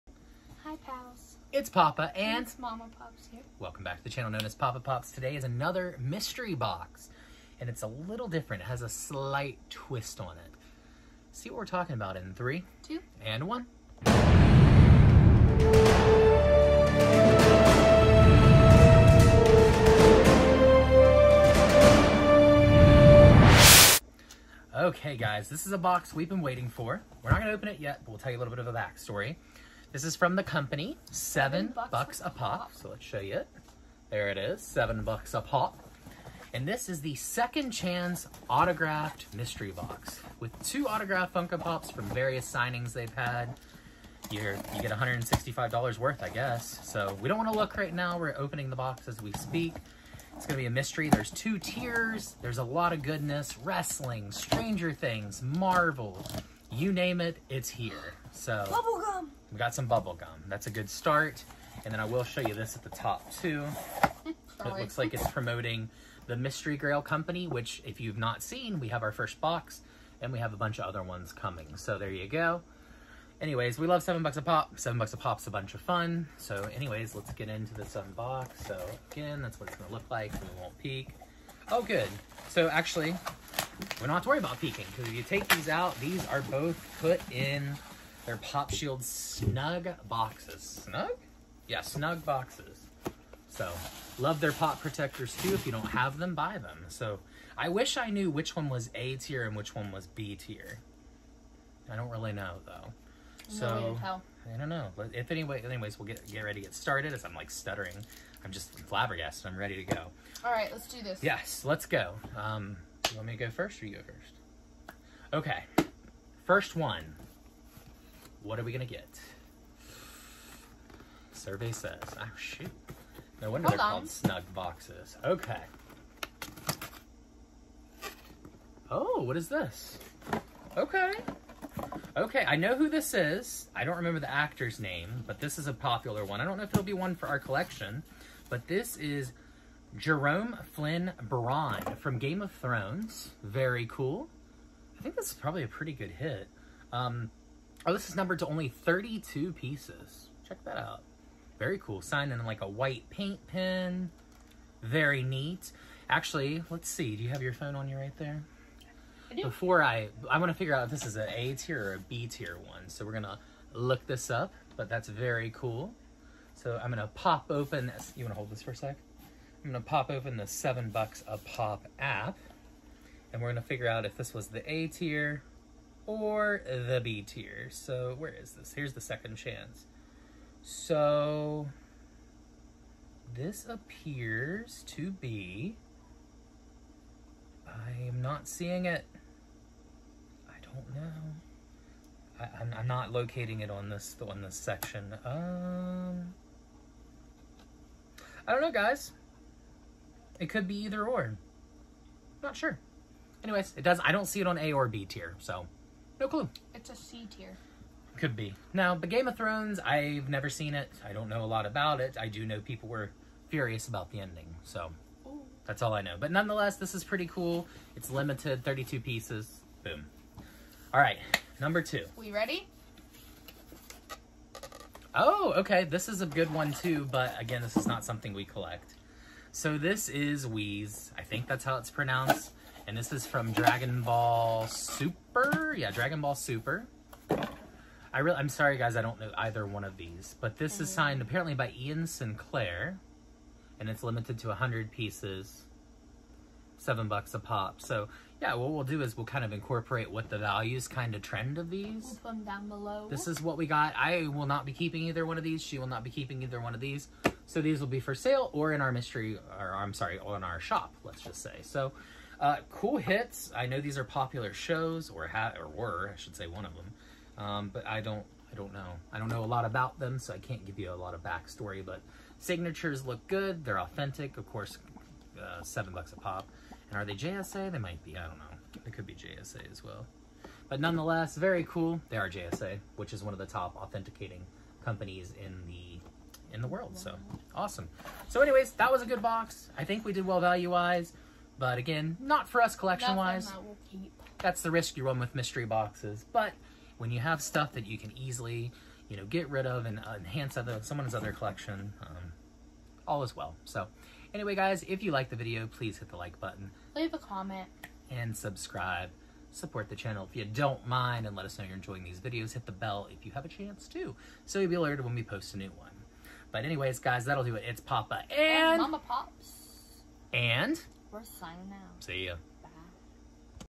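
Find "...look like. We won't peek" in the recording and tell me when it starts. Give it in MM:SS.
01:19.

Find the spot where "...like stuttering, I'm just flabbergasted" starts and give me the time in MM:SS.
01:47.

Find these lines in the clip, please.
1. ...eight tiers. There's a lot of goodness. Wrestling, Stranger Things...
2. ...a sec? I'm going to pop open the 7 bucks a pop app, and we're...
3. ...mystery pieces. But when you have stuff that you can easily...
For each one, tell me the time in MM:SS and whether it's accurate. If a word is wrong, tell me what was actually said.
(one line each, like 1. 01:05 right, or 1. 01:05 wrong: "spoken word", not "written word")
1. 00:51 wrong: "two", not "eight"
2. 02:48 right
3. 04:55 wrong: "boxes", not "pieces".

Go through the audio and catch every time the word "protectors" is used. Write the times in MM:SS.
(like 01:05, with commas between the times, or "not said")
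01:34.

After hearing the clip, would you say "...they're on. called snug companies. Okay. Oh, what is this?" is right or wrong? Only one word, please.
wrong.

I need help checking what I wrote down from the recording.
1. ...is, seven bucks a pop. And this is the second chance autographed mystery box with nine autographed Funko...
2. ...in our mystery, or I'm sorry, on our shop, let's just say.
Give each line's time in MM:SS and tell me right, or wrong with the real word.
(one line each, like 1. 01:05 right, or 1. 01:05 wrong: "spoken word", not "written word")
1. 00:34 wrong: "two", not "nine"
2. 04:18 right.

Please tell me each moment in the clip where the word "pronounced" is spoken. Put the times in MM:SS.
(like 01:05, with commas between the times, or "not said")
03:51.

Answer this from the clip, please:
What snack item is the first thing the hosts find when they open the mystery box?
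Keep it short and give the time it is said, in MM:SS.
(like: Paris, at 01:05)
Bubble gum, at 00:59.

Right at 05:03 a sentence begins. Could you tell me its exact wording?
So anyway, guys, if you like the video, please hit the like button.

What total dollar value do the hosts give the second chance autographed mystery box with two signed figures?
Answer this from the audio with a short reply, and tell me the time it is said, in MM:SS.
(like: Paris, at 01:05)
$165, at 00:44.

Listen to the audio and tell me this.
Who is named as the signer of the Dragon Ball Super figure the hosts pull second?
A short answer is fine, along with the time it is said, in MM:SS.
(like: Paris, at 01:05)
Ian Sinclair, at 04:01.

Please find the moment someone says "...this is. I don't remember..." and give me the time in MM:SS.
02:12.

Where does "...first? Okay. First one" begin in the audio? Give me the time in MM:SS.
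01:54.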